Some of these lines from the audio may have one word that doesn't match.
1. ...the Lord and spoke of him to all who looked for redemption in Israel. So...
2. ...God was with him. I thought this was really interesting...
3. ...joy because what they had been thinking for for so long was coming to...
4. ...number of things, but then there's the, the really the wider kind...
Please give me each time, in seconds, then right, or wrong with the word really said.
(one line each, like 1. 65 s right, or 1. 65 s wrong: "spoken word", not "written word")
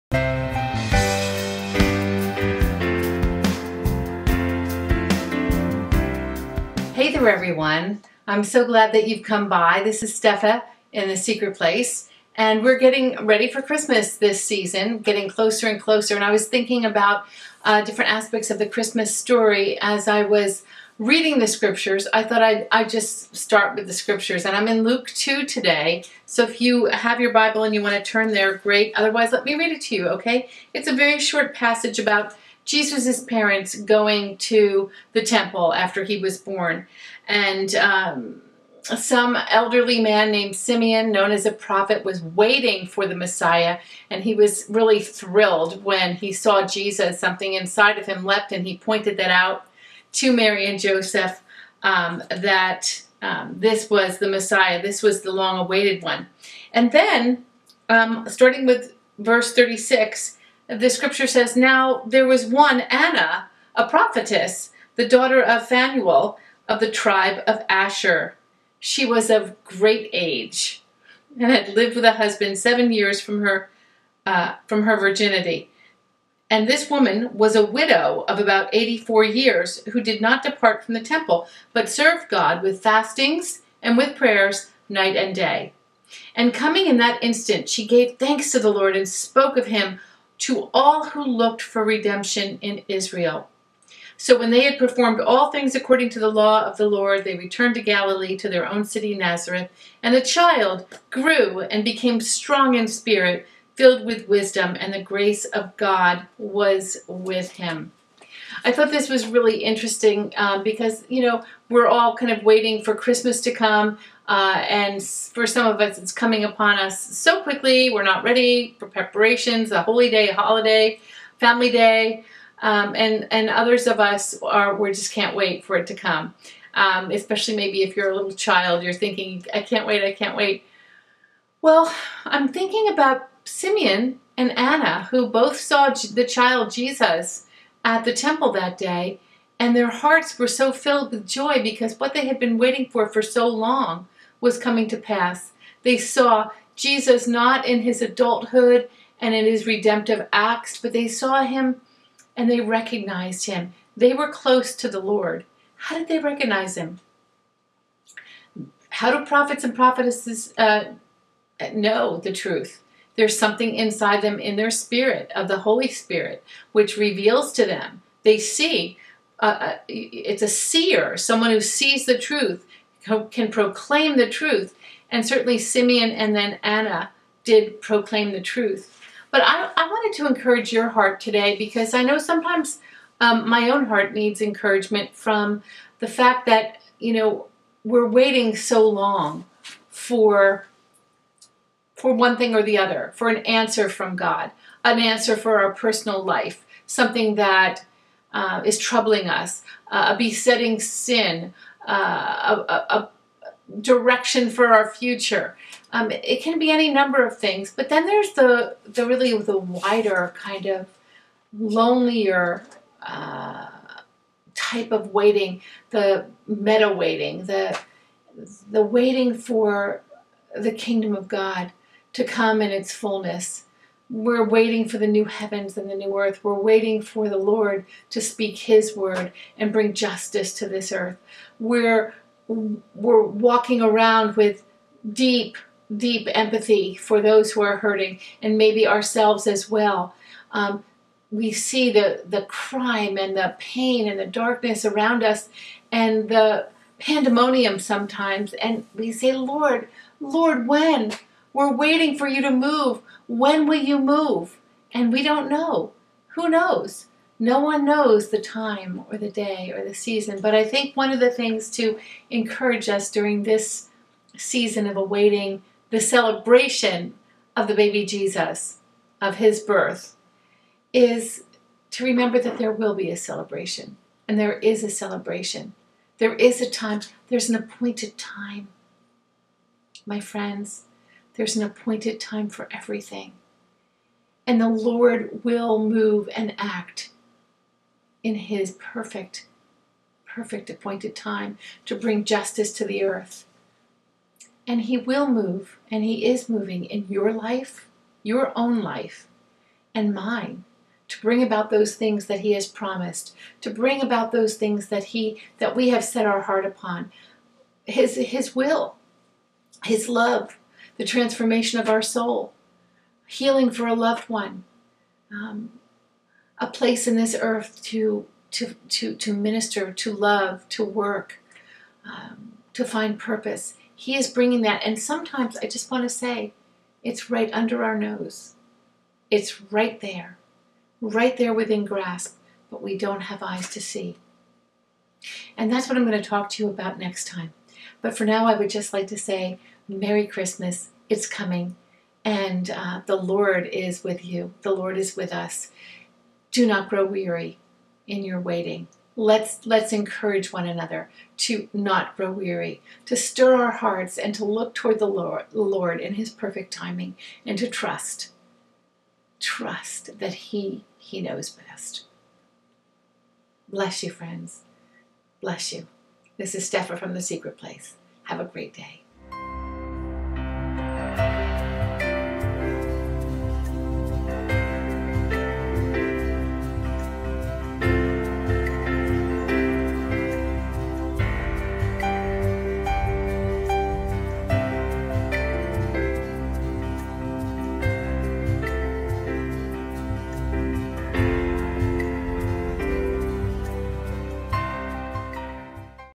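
1. 88 s right
2. 105 s right
3. 141 s wrong: "waiting", not "thinking"
4. 206 s right.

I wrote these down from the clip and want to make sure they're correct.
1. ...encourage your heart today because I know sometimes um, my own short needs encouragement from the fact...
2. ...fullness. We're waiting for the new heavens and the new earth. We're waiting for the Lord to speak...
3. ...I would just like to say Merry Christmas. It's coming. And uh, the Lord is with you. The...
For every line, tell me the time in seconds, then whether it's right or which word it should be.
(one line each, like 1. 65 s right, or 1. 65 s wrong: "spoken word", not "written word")
1. 180 s wrong: "heart", not "short"
2. 222 s right
3. 338 s right.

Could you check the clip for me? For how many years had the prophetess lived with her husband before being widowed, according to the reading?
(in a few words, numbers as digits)
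7.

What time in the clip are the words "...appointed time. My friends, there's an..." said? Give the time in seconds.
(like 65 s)
277 s.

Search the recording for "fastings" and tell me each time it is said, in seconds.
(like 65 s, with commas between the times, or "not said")
82 s.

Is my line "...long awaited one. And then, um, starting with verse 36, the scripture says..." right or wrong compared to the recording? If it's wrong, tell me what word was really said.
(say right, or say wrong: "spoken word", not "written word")
right.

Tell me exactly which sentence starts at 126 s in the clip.
Um, especially maybe if you're a little child, you're thinking, I can't wait, I can't wait.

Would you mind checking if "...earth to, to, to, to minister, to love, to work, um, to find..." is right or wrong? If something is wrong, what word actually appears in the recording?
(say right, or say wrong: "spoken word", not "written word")
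right.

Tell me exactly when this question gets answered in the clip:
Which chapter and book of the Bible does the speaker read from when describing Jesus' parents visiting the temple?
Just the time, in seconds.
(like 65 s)
24 s.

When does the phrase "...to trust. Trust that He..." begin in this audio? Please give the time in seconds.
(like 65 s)
357 s.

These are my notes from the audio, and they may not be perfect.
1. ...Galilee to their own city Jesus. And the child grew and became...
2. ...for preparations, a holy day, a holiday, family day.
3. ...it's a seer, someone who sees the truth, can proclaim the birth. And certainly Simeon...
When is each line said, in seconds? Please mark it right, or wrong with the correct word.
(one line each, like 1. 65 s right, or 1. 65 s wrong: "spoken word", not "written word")
1. 97 s wrong: "Nazareth", not "Jesus"
2. 118 s right
3. 169 s wrong: "truth", not "birth".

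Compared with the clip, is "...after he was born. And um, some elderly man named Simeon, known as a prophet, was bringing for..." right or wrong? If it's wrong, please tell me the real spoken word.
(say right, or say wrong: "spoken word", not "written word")
wrong: "waiting", not "bringing".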